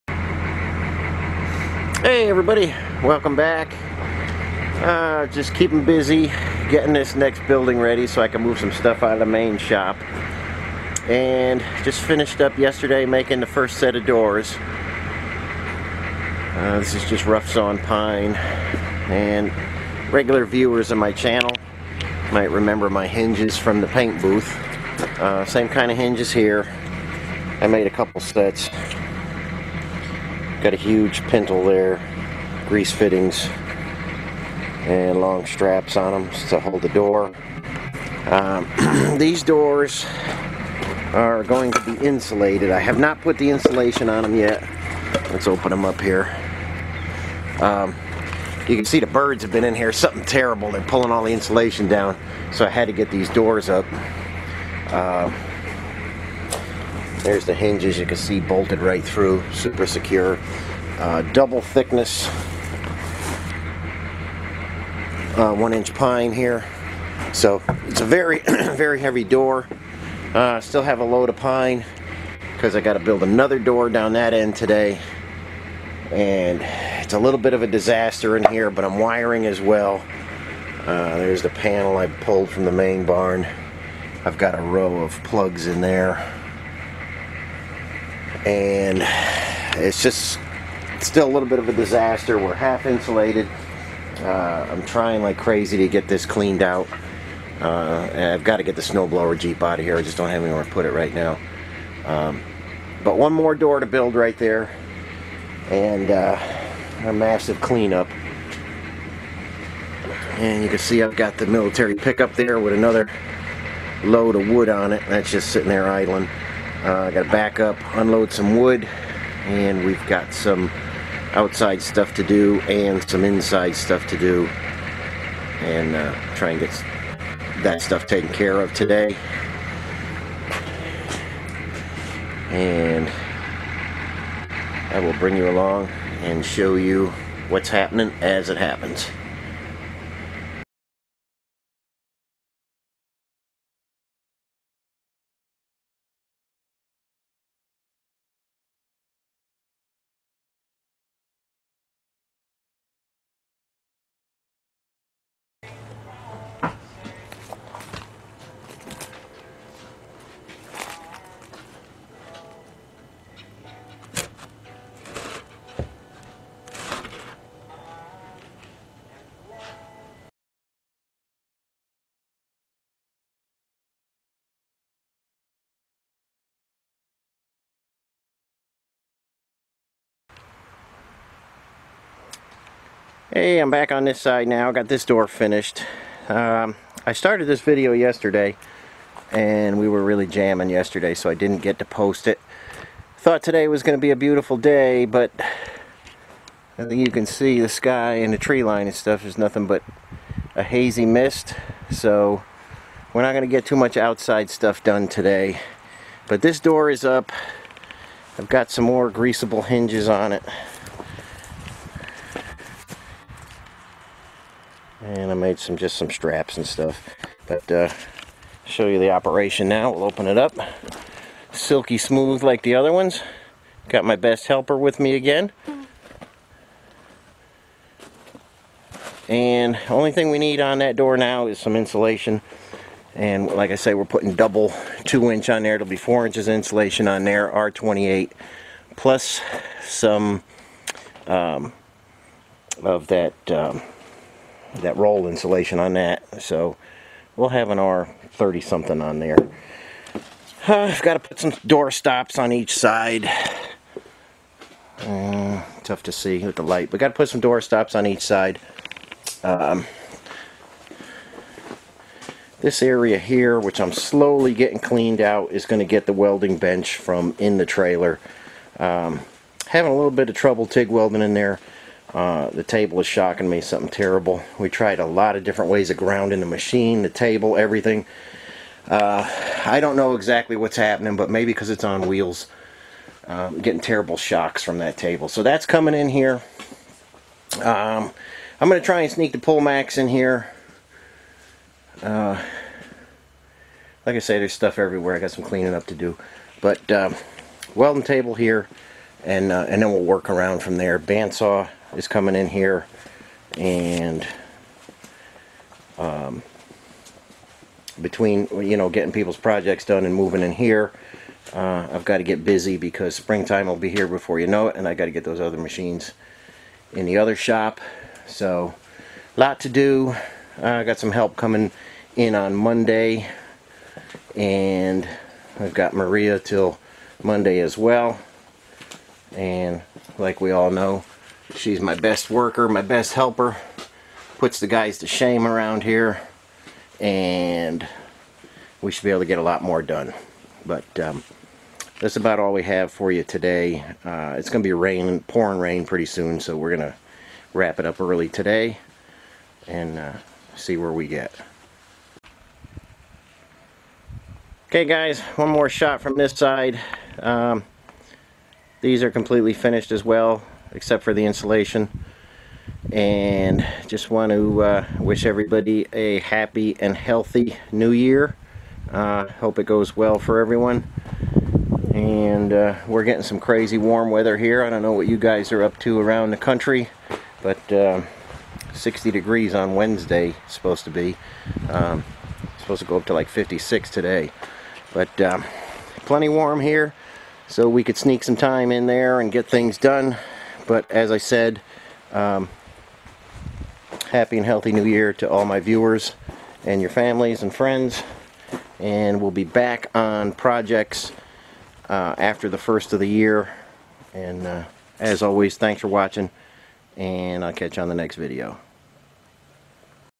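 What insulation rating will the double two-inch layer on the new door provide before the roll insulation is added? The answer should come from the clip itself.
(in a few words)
R28.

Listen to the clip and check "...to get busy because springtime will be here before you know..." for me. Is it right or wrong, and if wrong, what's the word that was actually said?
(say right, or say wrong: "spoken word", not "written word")
right.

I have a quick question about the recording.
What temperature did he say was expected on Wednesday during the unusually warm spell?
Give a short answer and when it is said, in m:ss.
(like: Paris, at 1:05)
60 degrees, at 6:18.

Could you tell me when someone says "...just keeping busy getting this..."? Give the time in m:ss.
0:05.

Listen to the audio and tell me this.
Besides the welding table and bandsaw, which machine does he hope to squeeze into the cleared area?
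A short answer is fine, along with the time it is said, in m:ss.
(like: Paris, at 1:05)
Pullmax, at 4:49.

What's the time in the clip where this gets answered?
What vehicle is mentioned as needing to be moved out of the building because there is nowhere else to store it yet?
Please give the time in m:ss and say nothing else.
1:38.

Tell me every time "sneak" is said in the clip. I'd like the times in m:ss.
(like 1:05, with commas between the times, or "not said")
4:49, 6:27.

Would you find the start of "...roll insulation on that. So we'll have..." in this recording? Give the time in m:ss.
4:04.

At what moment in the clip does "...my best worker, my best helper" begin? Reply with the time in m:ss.
5:31.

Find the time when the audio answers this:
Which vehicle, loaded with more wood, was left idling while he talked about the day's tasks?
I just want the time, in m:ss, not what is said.
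1:51.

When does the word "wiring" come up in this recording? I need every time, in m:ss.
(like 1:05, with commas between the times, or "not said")
1:18.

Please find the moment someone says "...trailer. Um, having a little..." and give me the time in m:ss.
4:27.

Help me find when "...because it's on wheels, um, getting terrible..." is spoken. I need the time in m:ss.
4:41.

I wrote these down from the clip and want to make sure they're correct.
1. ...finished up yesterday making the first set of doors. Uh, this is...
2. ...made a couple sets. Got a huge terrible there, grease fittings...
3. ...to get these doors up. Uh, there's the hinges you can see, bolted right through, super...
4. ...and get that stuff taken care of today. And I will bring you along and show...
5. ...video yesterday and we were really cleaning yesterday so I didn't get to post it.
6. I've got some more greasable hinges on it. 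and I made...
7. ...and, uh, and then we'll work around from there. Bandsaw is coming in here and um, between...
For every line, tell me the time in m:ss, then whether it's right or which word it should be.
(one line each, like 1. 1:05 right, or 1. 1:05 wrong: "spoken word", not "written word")
1. 0:12 right
2. 0:27 wrong: "pintle", not "terrible"
3. 0:52 right
4. 2:06 right
5. 3:07 wrong: "jamming", not "cleaning"
6. 3:28 right
7. 4:59 right.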